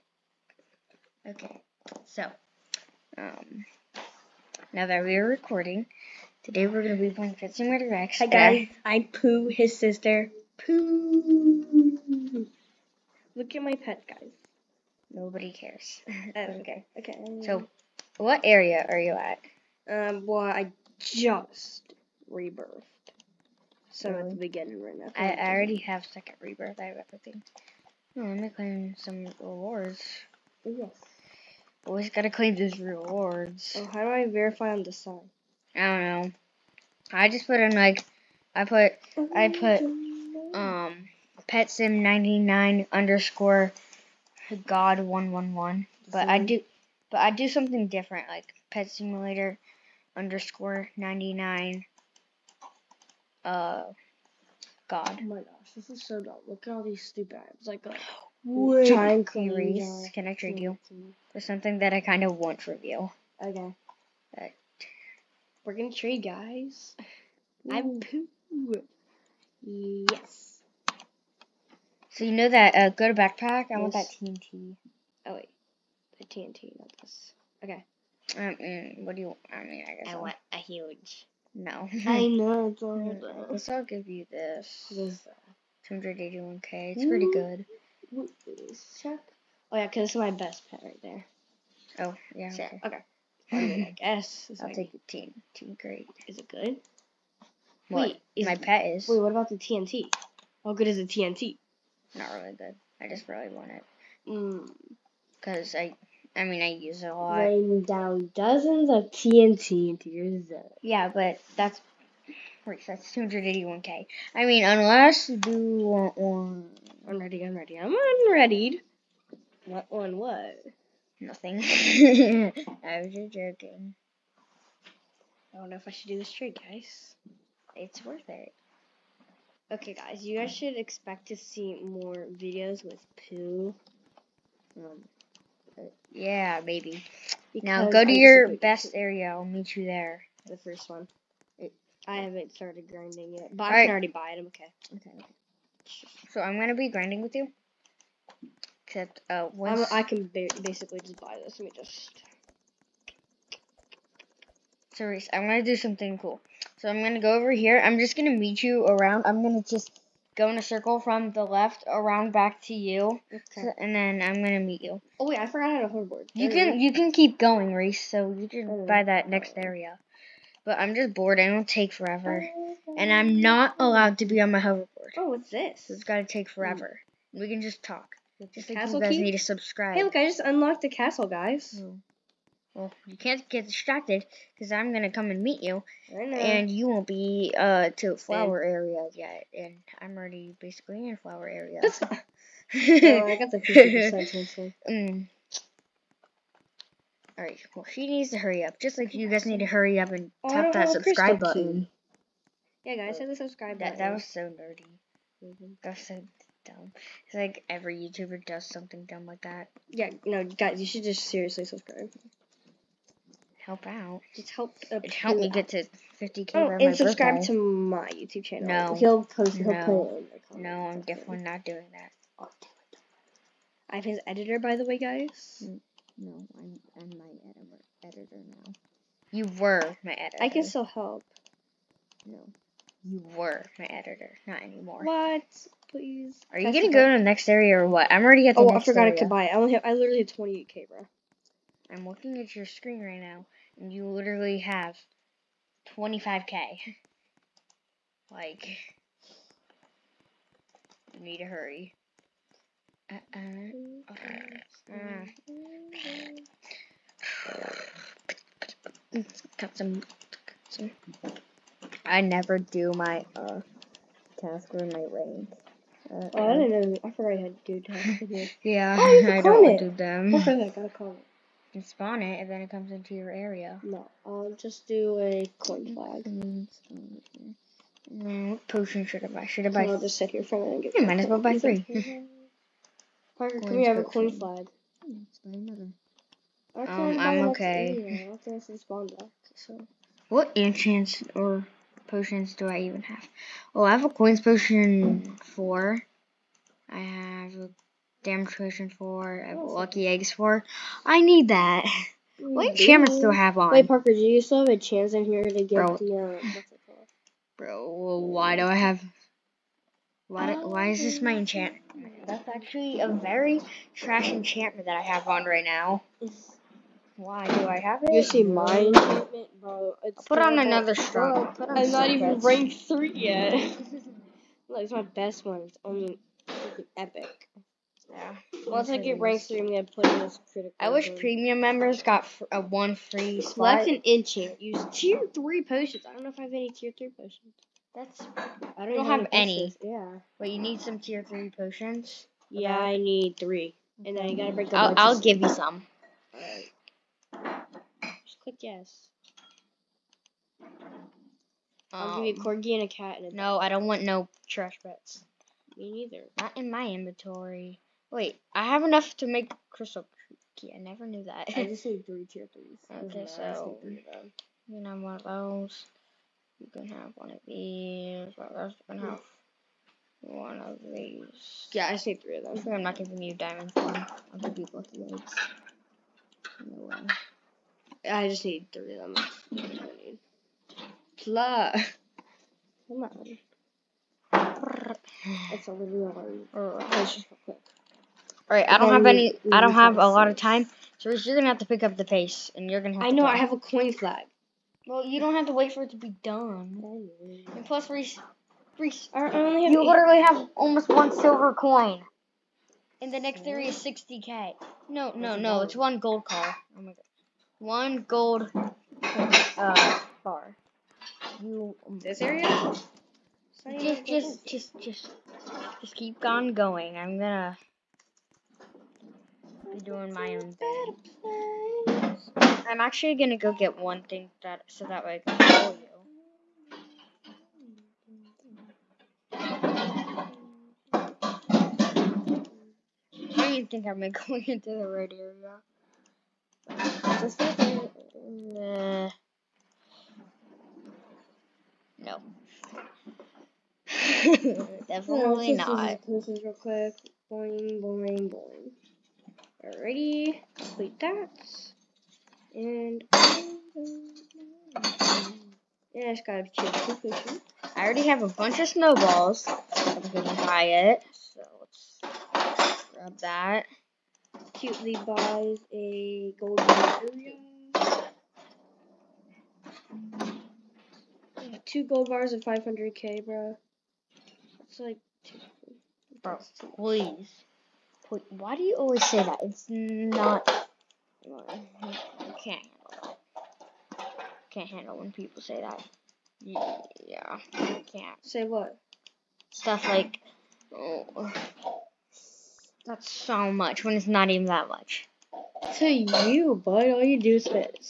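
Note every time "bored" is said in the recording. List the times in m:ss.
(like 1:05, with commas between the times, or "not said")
2:51.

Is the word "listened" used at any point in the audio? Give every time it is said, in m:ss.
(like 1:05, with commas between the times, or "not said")
not said.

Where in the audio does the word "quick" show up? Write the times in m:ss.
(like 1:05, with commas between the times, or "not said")
6:27, 7:26.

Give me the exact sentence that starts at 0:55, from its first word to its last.
Oh my gosh, this is so dumb.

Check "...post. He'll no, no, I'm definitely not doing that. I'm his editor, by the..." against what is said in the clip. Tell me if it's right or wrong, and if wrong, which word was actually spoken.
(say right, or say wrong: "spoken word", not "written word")
right.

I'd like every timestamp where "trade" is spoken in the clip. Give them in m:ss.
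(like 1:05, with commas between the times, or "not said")
1:00, 1:05, 2:06.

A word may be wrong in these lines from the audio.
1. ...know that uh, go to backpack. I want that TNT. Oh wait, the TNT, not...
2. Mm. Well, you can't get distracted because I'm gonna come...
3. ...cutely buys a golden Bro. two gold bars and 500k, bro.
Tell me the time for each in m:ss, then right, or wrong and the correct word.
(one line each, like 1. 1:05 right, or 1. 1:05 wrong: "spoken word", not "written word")
1. 1:12 right
2. 3:01 right
3. 7:44 wrong: "Ethereum", not "Bro".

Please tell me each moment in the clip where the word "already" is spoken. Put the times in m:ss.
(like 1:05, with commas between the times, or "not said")
0:25, 2:23, 3:10, 3:58, 7:37.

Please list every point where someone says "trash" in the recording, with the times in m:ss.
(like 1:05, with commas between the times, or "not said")
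5:13, 5:54.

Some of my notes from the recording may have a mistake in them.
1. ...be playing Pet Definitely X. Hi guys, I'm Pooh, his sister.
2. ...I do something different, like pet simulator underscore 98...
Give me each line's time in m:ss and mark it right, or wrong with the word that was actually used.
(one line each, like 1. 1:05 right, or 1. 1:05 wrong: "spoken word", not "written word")
1. 0:07 wrong: "Simulator", not "Definitely"
2. 0:47 wrong: "99", not "98".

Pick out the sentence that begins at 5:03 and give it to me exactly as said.
Wait, Parker, do you still have a chance in here to get Bro.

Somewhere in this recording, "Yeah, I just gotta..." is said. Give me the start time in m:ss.
7:35.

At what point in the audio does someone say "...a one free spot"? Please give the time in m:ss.
5:32.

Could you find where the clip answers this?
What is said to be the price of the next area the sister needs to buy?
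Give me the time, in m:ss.
6:43.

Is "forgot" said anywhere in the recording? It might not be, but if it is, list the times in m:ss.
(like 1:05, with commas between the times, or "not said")
2:45, 3:58, 4:27.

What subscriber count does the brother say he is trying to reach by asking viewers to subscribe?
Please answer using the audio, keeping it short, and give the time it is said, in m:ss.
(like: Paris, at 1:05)
50k, at 3:36.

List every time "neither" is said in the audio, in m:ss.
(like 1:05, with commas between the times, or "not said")
5:55.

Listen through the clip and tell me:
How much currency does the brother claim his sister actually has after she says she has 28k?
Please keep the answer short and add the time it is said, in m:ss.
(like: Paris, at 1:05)
25k, at 4:05.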